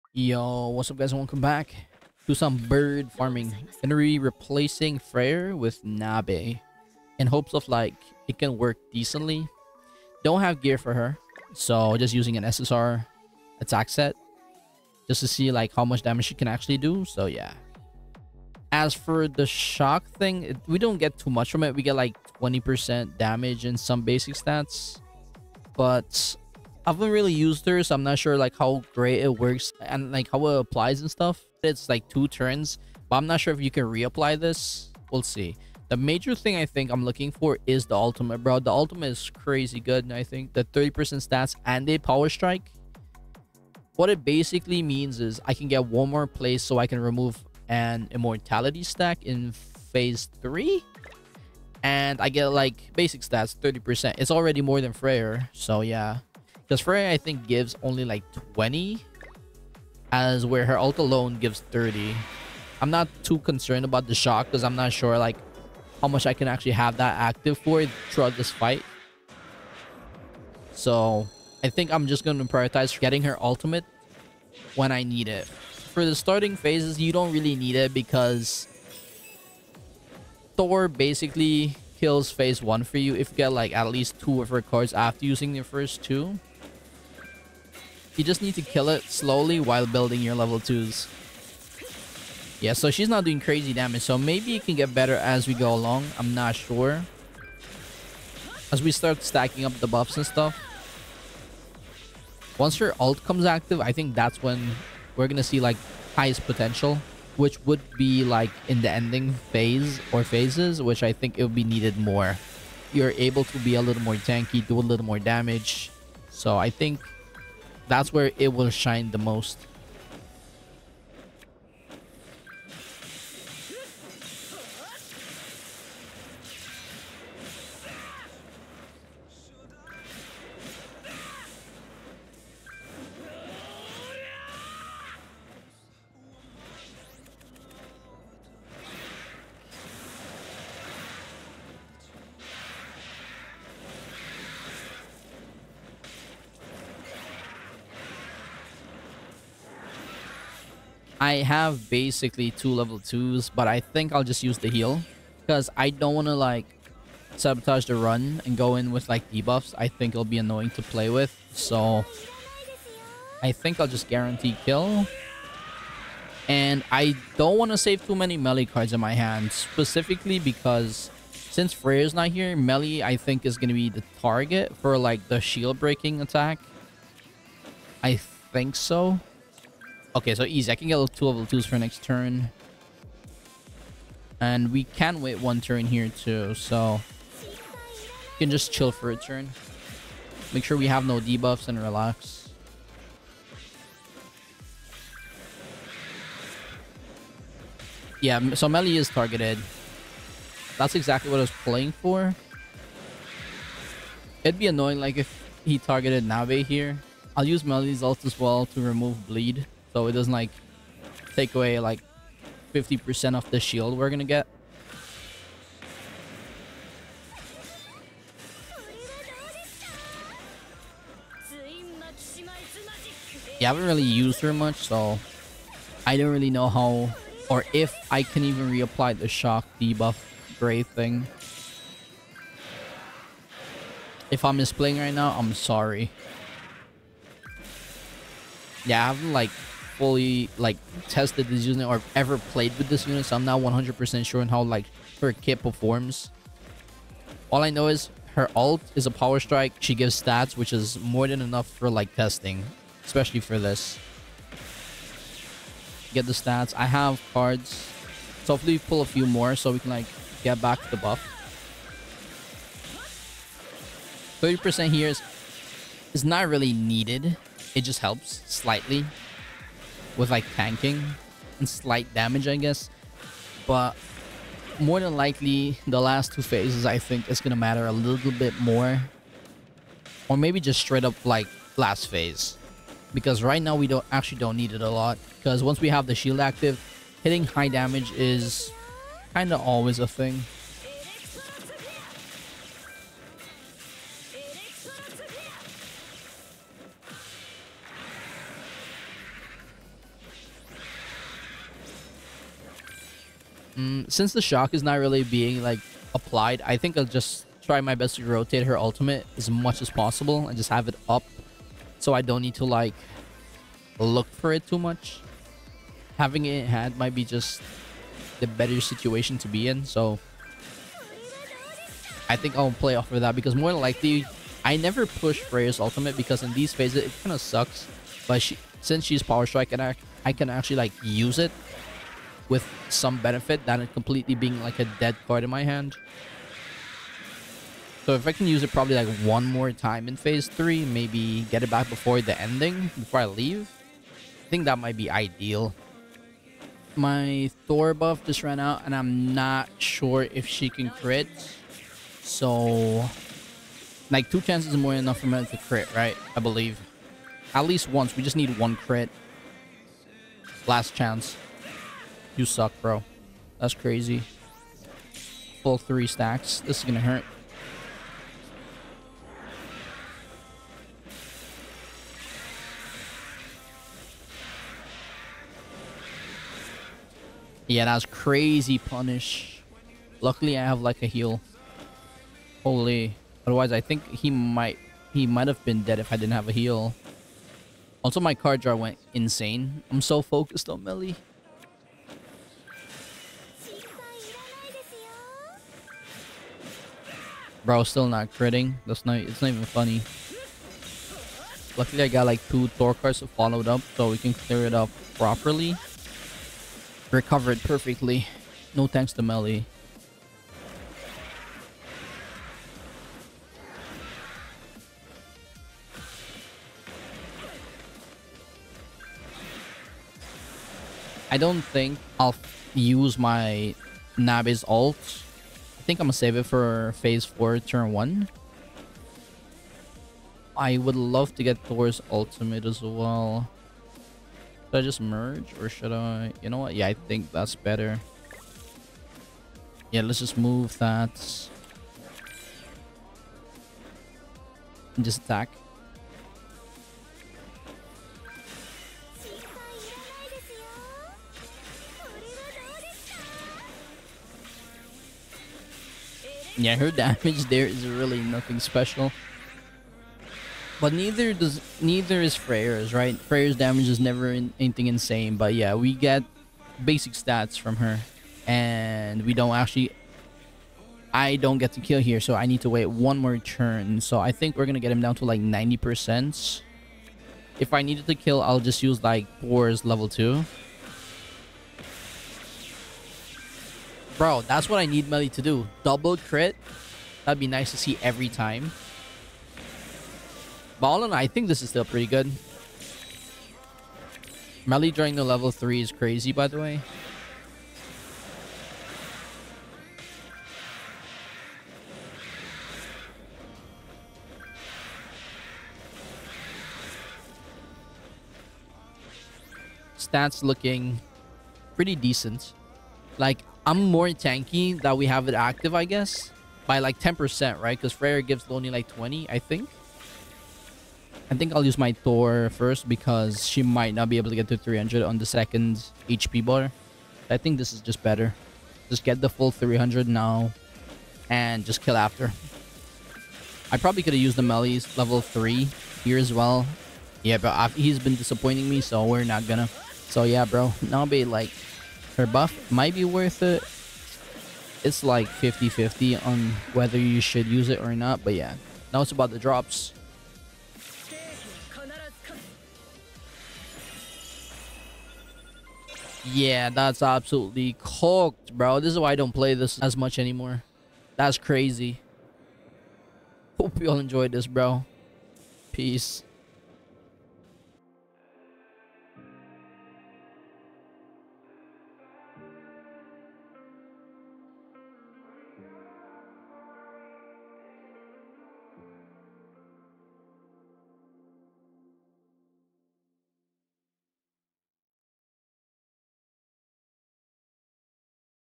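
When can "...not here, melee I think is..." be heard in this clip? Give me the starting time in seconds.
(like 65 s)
172 s.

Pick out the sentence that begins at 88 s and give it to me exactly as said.
You just need to kill it slowly while building your level 2s.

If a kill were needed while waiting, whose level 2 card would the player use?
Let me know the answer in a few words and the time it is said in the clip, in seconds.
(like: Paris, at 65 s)
Boar's, at 479 s.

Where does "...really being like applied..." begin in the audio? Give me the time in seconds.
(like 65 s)
304 s.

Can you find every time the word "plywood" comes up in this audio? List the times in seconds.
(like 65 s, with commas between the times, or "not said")
not said.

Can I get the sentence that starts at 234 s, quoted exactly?
If I'm misplaying right now, I'm sorry.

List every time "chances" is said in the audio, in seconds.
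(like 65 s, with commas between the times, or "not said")
354 s, 360 s.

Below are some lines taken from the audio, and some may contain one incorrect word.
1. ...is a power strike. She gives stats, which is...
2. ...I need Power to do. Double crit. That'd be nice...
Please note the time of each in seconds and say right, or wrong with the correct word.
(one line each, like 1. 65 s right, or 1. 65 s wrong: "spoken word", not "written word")
1. 248 s right
2. 484 s wrong: "Melly", not "Power".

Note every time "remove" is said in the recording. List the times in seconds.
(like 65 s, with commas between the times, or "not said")
46 s, 208 s.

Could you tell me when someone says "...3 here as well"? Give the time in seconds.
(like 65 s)
535 s.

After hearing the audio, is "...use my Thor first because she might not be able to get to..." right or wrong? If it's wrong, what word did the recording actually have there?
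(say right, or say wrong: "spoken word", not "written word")
right.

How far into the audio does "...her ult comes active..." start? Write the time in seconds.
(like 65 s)
102 s.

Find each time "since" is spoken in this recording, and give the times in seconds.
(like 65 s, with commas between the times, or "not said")
171 s, 304 s, 328 s.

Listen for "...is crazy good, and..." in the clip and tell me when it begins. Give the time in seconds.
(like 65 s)
39 s.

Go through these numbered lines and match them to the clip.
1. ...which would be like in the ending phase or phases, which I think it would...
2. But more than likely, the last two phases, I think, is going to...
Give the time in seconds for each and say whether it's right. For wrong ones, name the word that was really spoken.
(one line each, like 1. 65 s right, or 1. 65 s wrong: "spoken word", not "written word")
1. 107 s right
2. 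273 s right.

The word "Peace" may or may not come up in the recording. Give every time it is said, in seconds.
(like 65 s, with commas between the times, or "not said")
565 s.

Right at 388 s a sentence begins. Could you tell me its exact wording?
Also, my card draw went insane.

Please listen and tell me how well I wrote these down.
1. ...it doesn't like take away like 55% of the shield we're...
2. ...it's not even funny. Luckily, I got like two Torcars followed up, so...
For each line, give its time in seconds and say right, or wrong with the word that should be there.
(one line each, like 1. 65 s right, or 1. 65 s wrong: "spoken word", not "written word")
1. 210 s wrong: "50", not "55"
2. 399 s right.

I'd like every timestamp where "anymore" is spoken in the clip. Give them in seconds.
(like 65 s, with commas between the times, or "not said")
560 s.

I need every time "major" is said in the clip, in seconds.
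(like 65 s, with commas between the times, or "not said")
35 s.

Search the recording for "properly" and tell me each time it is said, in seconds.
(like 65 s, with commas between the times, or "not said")
405 s.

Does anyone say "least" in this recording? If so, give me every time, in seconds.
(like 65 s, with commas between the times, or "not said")
83 s, 357 s.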